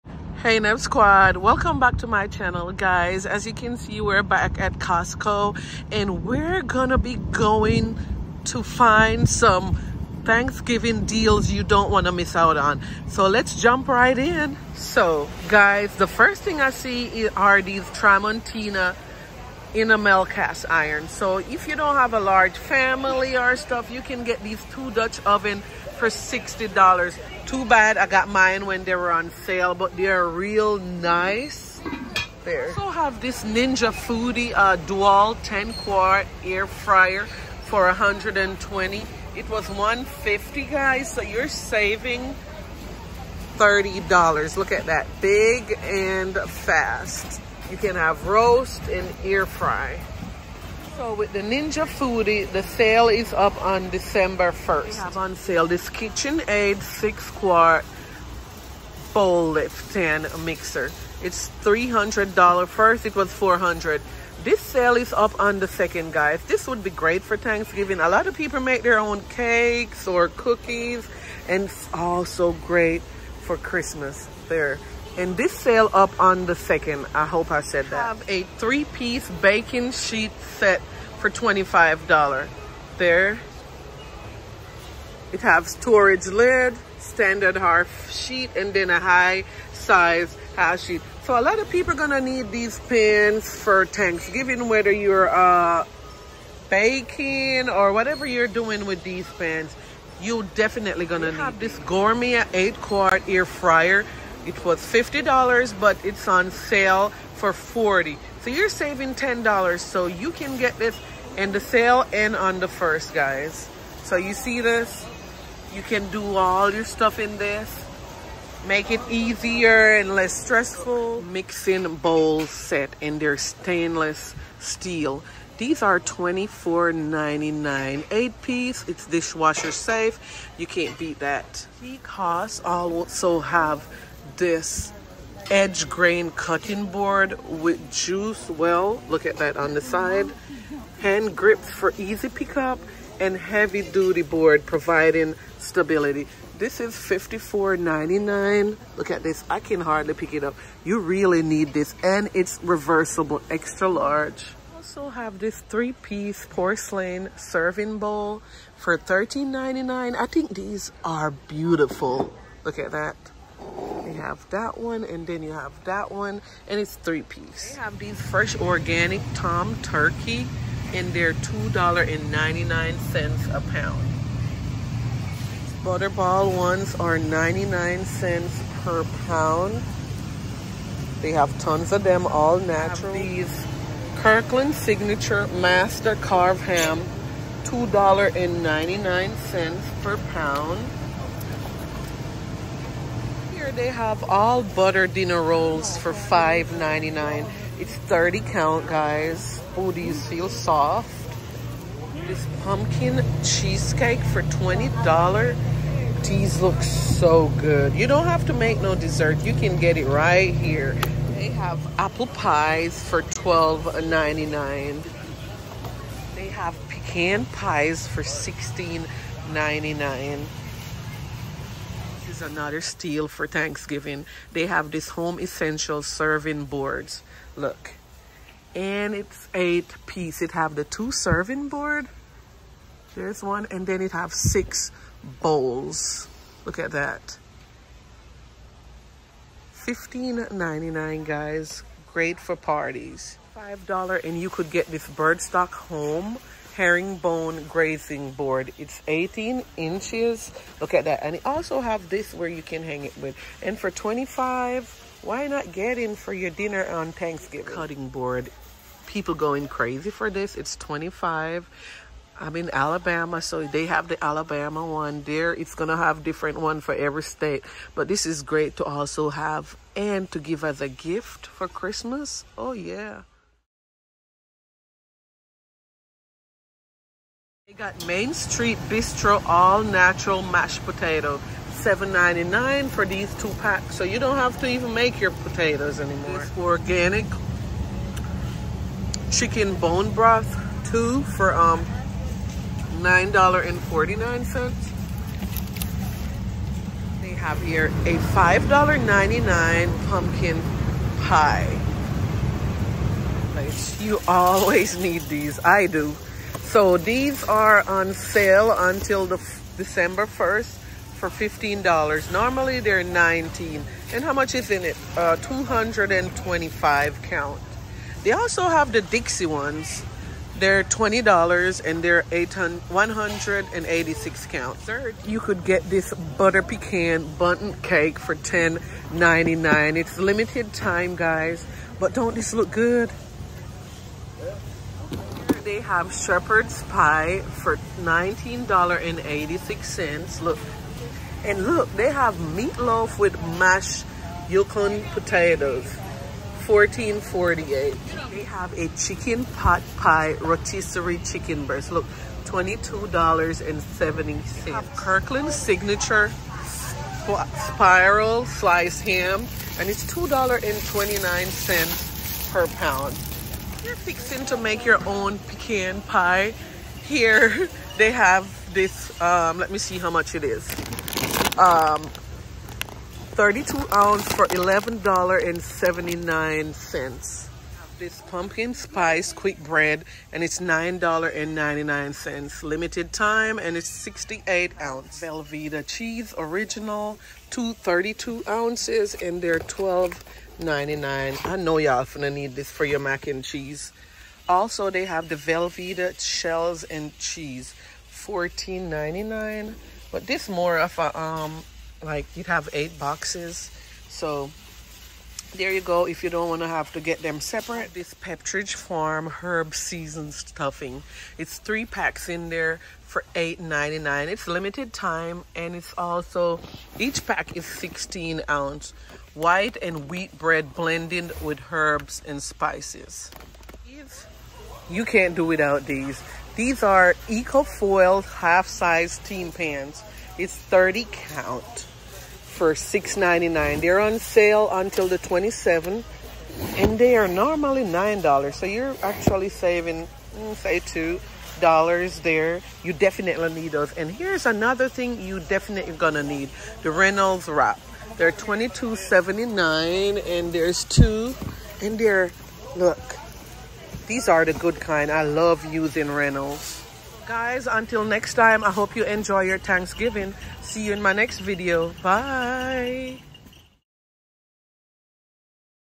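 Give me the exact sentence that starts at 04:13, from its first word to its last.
And for 25, why not get in for your dinner on Thanksgiving?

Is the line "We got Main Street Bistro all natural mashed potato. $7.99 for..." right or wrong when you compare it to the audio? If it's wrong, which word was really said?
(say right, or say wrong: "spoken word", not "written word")
right.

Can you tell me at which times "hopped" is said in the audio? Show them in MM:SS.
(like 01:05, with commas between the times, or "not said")
not said.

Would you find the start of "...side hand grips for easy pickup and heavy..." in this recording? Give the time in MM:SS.
02:19.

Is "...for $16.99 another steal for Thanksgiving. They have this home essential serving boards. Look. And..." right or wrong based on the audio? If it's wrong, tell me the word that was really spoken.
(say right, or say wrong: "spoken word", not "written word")
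right.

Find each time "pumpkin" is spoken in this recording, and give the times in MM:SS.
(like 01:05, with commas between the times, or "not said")
03:22, 05:00, 06:18.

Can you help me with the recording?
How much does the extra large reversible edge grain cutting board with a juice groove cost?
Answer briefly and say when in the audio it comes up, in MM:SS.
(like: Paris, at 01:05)
$54.99, at 02:26.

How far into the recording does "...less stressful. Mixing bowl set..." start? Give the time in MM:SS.
02:00.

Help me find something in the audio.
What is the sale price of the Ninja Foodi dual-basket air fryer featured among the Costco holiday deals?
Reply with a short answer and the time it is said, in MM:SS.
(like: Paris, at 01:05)
$120, at 00:37.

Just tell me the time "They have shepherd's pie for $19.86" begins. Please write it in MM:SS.
05:35.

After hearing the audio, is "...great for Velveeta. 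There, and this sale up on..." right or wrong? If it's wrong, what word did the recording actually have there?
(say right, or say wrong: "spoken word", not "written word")
wrong: "Christmas", not "Velveeta".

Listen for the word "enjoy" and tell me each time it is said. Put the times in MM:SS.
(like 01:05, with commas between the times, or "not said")
07:39.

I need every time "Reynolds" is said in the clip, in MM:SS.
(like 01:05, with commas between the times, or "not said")
07:26, 07:36.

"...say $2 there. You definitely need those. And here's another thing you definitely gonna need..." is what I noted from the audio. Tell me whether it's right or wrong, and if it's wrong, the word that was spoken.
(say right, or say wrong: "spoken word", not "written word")
right.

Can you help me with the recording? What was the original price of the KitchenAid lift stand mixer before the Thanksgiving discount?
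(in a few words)
$400.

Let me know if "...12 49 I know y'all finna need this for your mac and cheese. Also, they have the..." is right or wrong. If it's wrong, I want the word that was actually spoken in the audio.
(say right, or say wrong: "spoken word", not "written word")
wrong: "99", not "49".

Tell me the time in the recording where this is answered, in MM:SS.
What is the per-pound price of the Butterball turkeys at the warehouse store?
02:57.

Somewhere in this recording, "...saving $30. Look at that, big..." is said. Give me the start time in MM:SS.
00:41.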